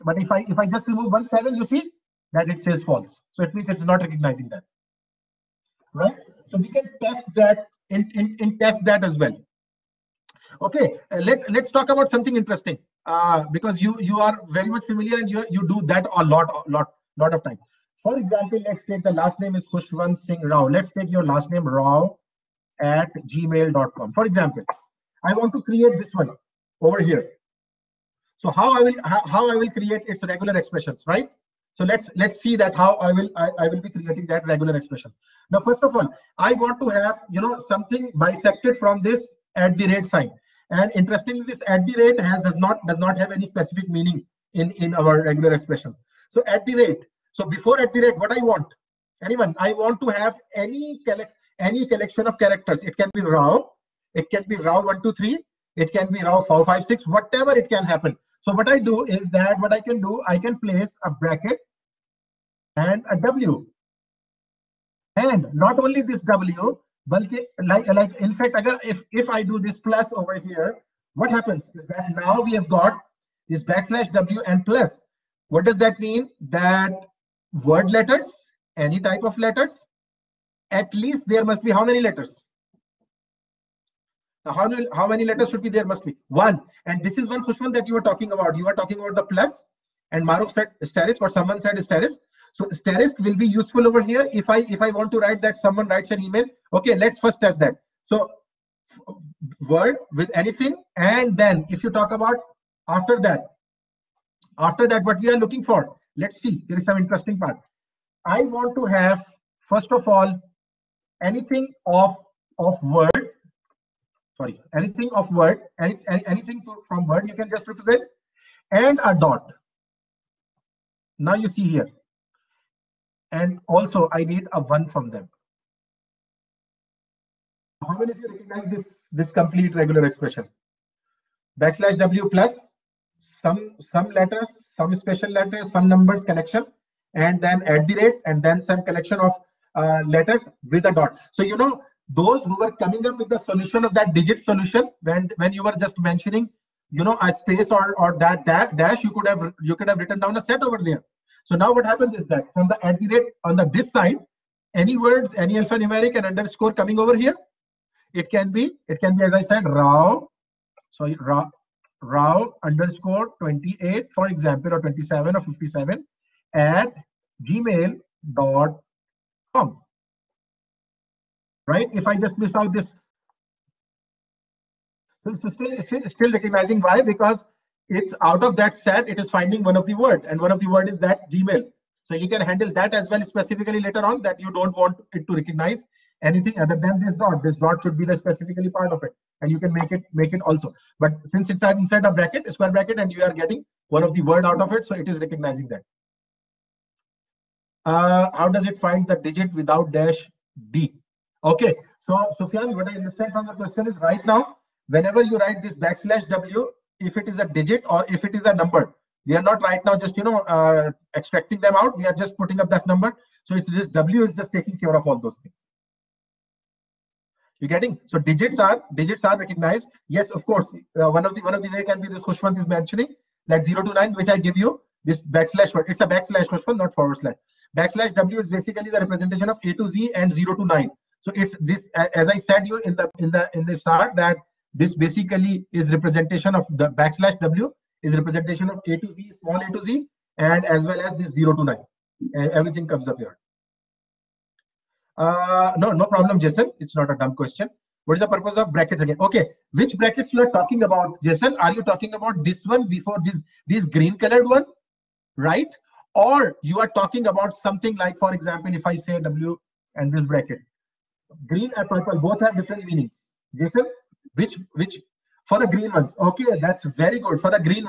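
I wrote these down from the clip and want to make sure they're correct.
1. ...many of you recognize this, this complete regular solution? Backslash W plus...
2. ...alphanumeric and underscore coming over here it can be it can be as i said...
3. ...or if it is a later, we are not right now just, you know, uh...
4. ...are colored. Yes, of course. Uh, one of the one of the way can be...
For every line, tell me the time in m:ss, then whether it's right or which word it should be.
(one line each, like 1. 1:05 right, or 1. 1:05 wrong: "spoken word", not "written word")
1. 2:07 wrong: "expression", not "solution"
2. 2:35 right
3. 3:27 wrong: "number", not "later"
4. 3:39 wrong: "recognized", not "colored".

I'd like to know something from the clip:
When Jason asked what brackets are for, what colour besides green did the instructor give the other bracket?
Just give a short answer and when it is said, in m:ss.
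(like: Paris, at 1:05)
purple, at 4:21.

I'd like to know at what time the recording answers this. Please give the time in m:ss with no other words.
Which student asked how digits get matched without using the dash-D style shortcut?
3:22.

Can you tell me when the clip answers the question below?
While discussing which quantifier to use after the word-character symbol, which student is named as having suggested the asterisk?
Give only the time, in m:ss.
1:30.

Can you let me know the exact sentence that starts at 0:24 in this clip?
For example, I want to create this one over here.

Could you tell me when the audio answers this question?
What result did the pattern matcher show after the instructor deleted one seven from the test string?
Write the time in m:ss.
0:02.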